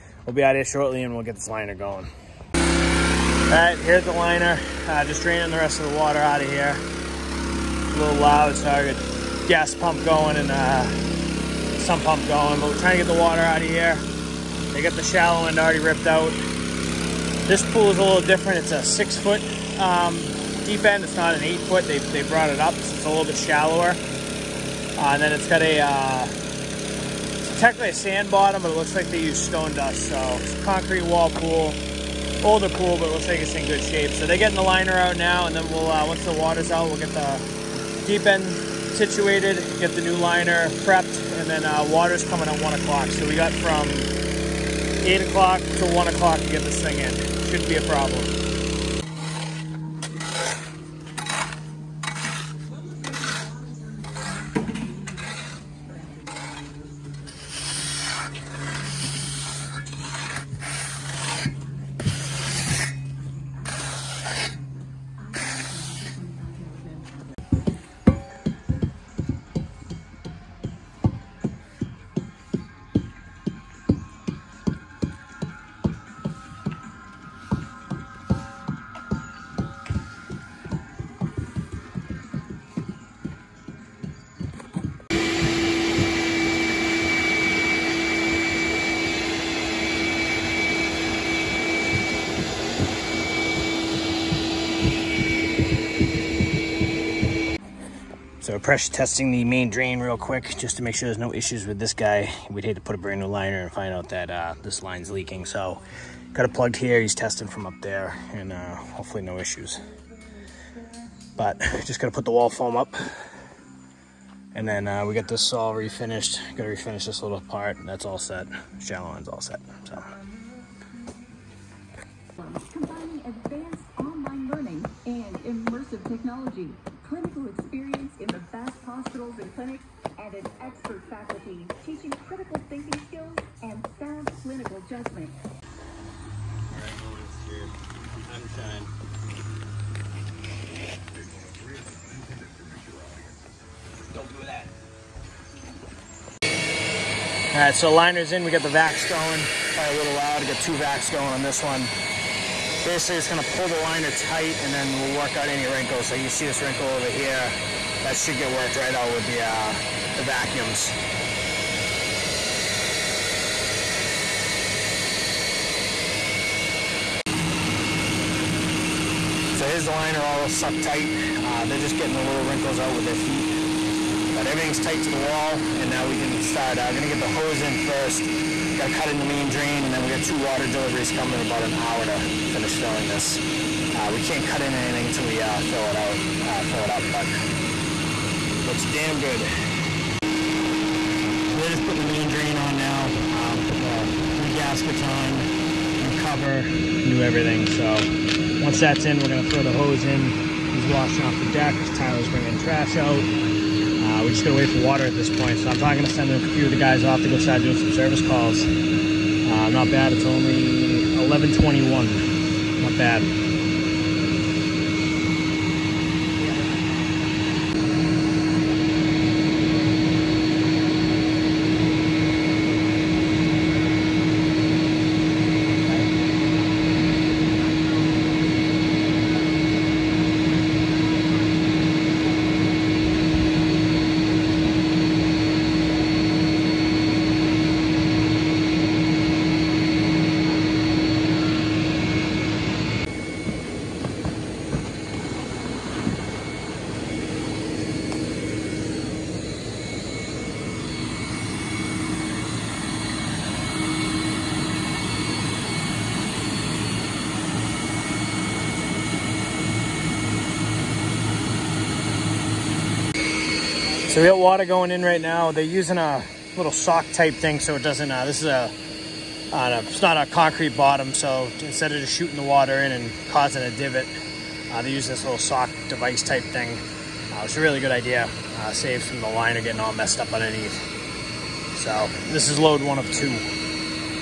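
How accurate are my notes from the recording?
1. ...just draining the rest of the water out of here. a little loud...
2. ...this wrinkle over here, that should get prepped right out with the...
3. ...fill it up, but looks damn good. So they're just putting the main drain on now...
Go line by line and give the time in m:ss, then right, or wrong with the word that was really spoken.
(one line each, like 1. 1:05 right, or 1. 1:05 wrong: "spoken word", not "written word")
1. 0:05 right
2. 2:36 wrong: "worked", not "prepped"
3. 3:06 right.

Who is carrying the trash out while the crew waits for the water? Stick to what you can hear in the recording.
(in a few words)
Tyler.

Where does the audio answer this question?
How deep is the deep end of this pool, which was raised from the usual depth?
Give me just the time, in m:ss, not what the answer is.
0:18.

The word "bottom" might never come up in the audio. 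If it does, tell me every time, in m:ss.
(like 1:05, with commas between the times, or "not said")
0:28, 4:30.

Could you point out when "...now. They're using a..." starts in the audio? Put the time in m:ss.
4:25.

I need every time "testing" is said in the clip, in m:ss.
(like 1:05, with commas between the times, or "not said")
1:38, 1:47.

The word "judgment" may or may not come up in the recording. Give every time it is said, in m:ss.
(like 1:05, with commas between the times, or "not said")
2:14.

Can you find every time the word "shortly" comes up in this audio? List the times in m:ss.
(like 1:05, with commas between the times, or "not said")
0:00.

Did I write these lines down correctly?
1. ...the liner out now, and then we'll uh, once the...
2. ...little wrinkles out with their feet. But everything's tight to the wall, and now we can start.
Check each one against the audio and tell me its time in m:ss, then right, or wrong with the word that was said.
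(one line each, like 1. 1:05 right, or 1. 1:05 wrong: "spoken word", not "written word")
1. 0:34 right
2. 2:52 right.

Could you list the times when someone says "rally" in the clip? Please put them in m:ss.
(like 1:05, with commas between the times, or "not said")
not said.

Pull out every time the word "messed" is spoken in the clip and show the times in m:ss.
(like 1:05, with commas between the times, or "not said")
4:39.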